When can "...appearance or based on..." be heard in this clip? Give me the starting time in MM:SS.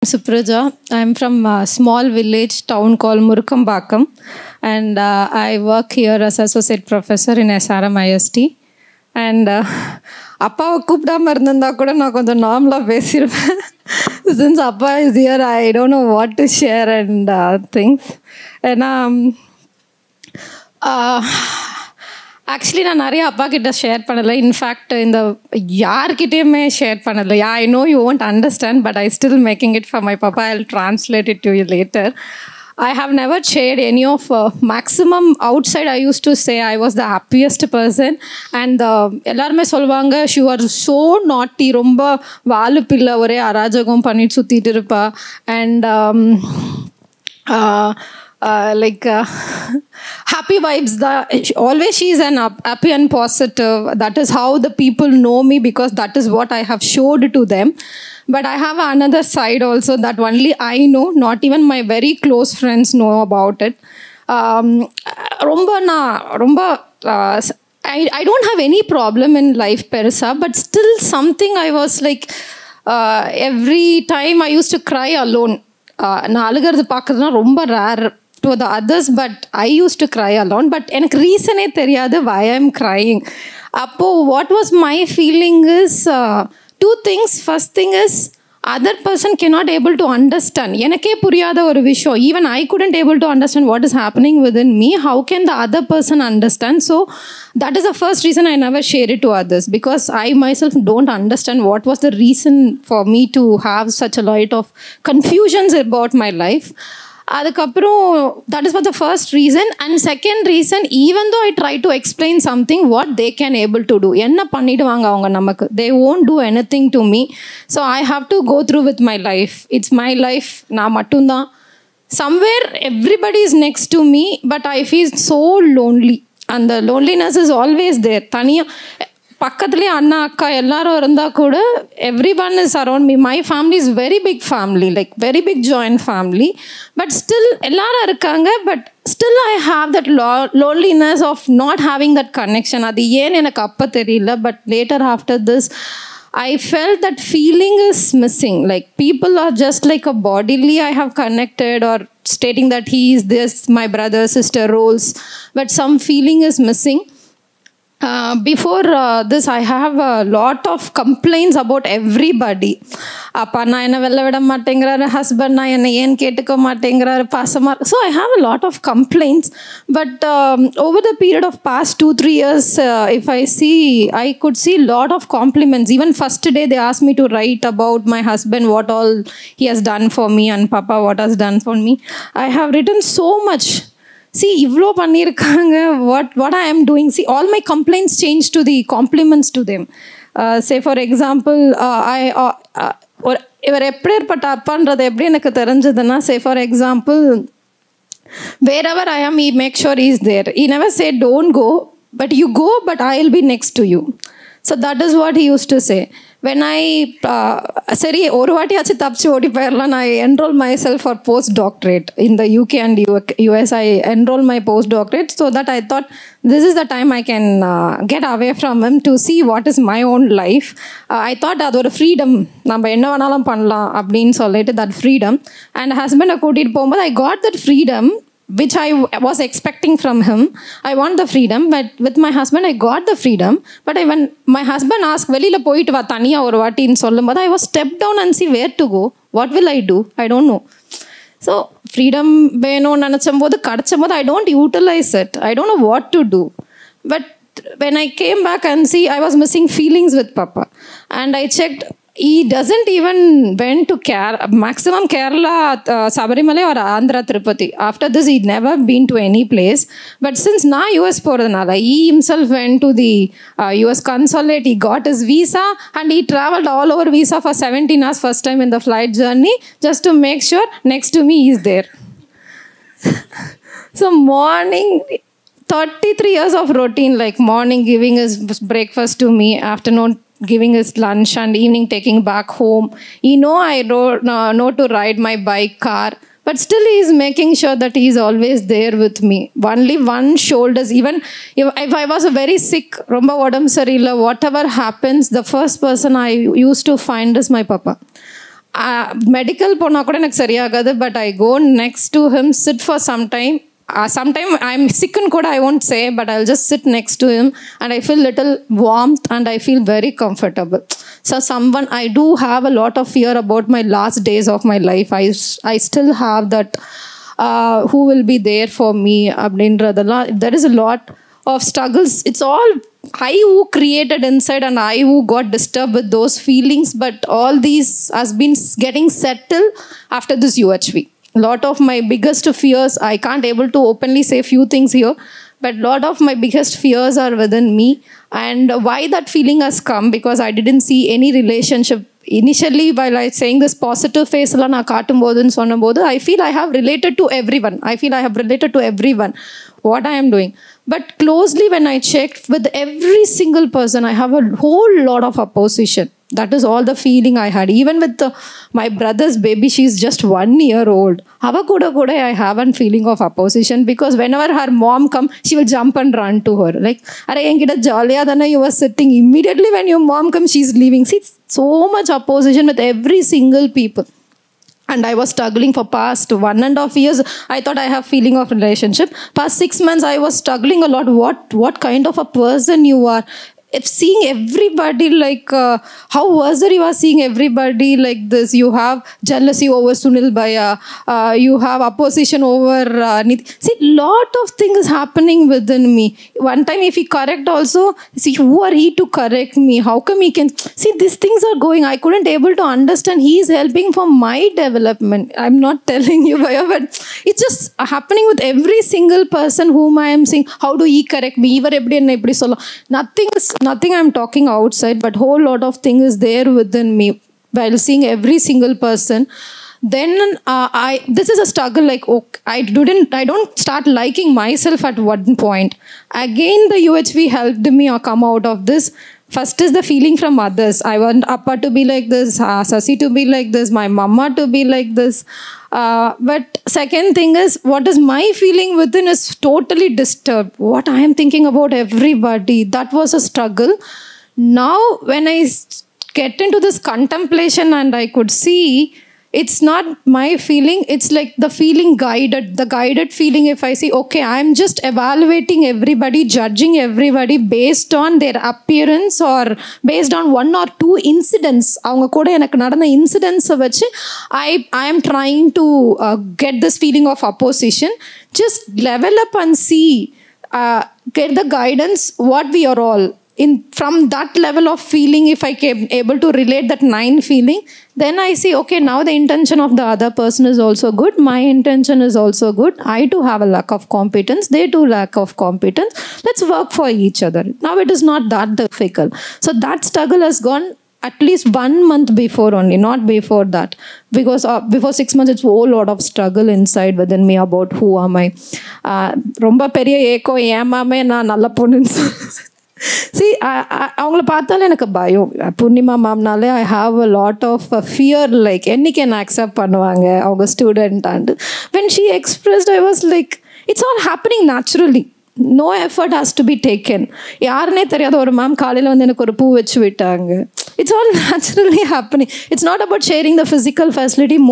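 07:38.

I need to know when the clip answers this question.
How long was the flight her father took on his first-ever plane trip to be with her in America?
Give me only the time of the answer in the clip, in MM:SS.
04:27.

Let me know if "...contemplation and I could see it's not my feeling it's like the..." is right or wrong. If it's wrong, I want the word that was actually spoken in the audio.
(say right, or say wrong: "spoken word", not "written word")
right.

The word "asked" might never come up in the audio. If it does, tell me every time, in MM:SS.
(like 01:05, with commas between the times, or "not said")
02:56, 03:55.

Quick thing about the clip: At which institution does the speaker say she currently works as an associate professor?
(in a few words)
SRM IST.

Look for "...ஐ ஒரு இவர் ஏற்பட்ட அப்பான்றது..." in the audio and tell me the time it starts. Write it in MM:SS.
03:12.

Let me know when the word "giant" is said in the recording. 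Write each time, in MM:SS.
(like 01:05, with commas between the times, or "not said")
not said.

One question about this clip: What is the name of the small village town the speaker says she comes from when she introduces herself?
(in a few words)
Murukambakam.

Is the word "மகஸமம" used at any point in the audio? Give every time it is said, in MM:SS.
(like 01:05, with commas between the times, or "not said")
00:34.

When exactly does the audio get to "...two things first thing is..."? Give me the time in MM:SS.
01:26.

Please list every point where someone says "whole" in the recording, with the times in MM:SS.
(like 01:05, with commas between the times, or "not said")
05:54, 06:55, 08:15.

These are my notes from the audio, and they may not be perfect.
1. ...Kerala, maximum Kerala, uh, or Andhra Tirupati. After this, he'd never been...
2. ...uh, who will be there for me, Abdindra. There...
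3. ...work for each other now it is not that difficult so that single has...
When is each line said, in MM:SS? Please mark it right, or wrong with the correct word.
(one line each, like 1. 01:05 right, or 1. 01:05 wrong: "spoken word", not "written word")
1. 04:13 right
2. 05:17 right
3. 08:06 wrong: "struggle", not "single".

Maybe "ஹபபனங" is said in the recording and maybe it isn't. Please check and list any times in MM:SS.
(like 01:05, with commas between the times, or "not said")
01:33, 08:34, 08:41.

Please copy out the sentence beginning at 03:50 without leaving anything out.
I want the freedom, but with my husband, I got the freedom.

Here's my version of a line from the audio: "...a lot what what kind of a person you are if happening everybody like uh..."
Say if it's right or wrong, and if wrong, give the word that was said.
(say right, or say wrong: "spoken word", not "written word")
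wrong: "seeing", not "happening".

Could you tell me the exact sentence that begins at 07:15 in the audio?
Uh, but second thing is, what is my feeling within is totally disturbed.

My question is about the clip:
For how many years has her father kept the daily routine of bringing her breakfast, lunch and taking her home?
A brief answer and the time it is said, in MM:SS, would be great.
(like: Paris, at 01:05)
33 years, at 04:35.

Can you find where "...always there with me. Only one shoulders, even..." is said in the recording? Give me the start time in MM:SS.
04:48.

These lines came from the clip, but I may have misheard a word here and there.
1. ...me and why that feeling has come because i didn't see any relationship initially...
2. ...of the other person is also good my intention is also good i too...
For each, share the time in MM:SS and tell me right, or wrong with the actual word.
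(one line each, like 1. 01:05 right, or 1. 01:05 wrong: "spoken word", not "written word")
1. 05:37 right
2. 07:59 right.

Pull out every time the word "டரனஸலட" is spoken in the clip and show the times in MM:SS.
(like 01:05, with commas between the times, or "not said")
00:30.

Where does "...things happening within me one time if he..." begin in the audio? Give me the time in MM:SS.
06:34.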